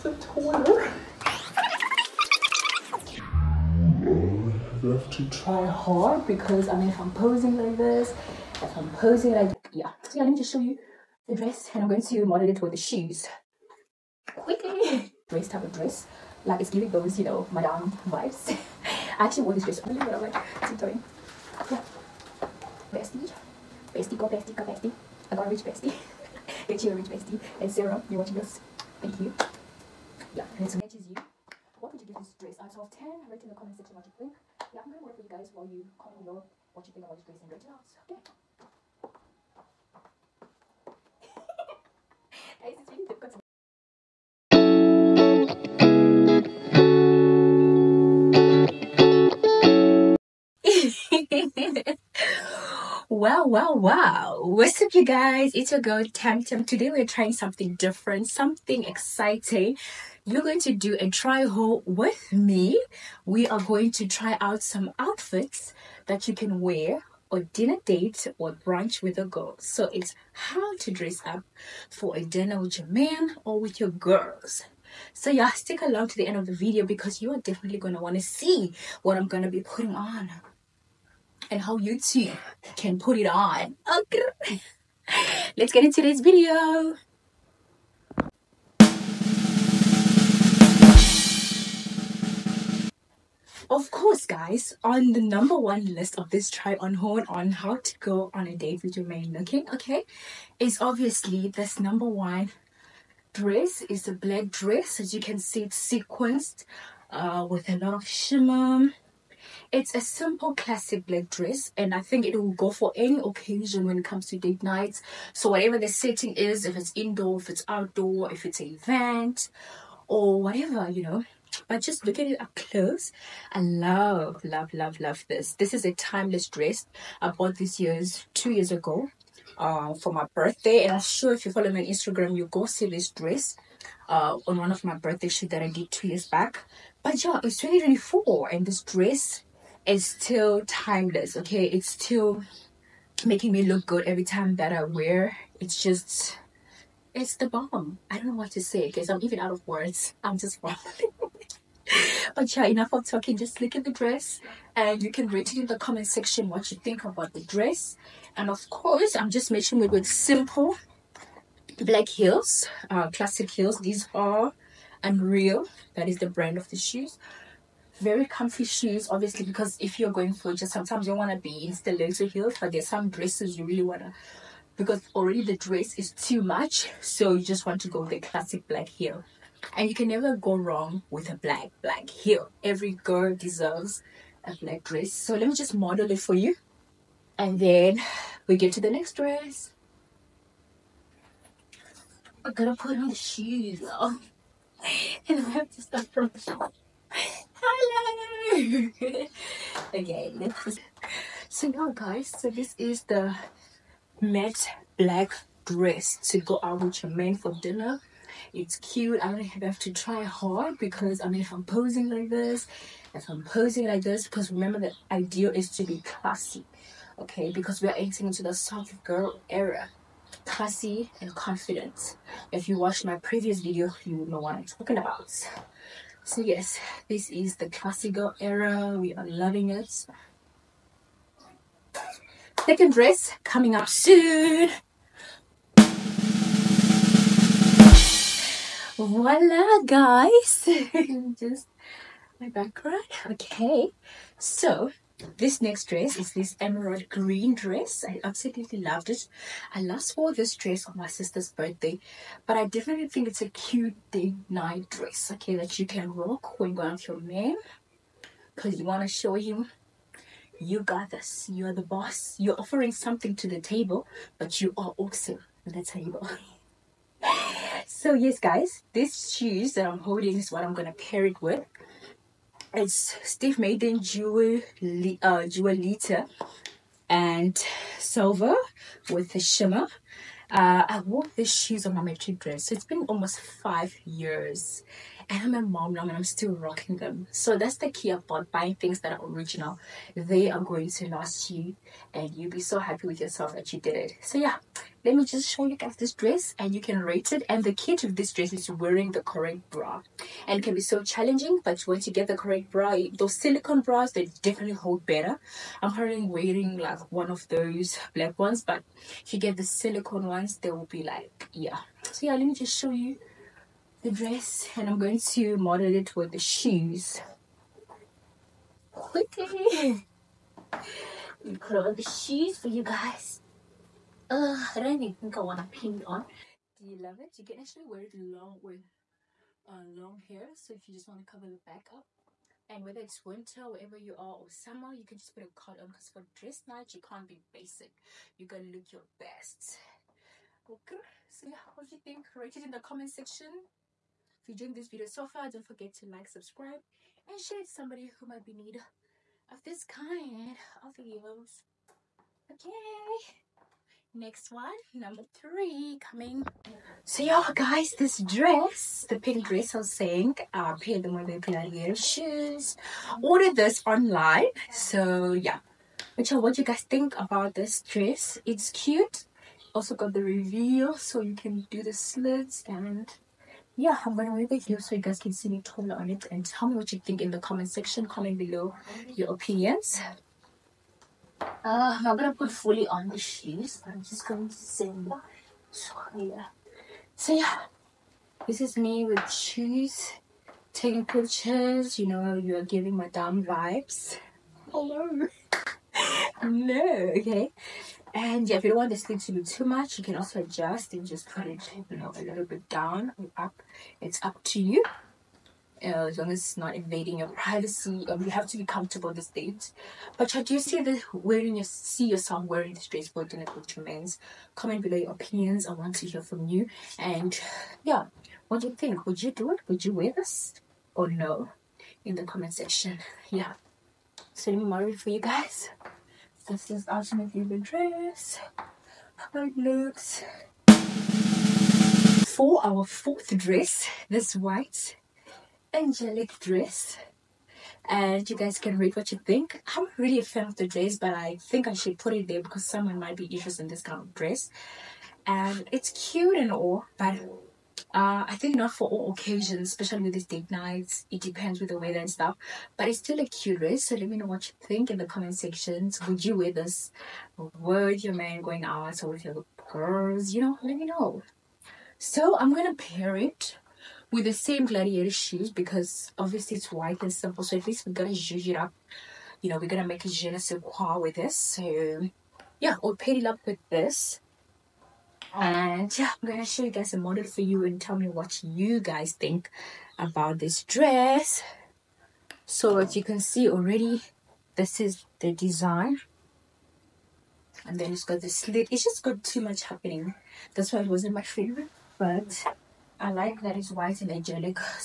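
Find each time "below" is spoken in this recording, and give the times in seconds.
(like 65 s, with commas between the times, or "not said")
36 s, 378 s, 414 s.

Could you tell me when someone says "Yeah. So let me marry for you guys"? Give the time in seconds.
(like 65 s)
423 s.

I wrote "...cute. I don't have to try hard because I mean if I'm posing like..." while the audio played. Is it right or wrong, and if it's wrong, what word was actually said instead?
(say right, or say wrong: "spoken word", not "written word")
right.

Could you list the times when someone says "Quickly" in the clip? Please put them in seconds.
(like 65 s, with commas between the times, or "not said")
14 s, 318 s.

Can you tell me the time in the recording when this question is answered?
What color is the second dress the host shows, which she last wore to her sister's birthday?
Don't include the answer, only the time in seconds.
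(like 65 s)
246 s.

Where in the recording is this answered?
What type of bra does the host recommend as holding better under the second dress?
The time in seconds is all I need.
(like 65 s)
303 s.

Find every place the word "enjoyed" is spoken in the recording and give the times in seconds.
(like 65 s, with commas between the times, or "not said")
344 s.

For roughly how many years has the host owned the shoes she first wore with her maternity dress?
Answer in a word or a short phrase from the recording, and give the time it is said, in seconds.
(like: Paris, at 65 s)
5, at 283 s.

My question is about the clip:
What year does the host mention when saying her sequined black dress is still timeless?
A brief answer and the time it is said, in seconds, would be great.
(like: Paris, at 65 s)
2024, at 137 s.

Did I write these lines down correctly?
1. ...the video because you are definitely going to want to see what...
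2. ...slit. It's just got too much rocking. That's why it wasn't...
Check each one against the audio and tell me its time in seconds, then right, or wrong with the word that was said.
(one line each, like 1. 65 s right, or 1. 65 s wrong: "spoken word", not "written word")
1. 76 s right
2. 488 s wrong: "happening", not "rocking".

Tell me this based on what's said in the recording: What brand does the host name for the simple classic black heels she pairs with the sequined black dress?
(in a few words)
Unreal.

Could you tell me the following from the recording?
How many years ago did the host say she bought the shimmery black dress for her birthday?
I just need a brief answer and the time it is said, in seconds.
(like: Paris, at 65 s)
2, at 128 s.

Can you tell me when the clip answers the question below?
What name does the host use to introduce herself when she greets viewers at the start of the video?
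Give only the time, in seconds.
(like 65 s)
56 s.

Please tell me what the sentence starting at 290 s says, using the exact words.
They are going to last you and you'll be so happy with yourself that you did it.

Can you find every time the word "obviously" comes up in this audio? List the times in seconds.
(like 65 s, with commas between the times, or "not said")
100 s, 169 s, 466 s.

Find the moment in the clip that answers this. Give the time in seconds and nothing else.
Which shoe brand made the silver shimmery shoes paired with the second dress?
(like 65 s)
273 s.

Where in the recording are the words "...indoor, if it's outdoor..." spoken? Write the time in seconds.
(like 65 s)
116 s.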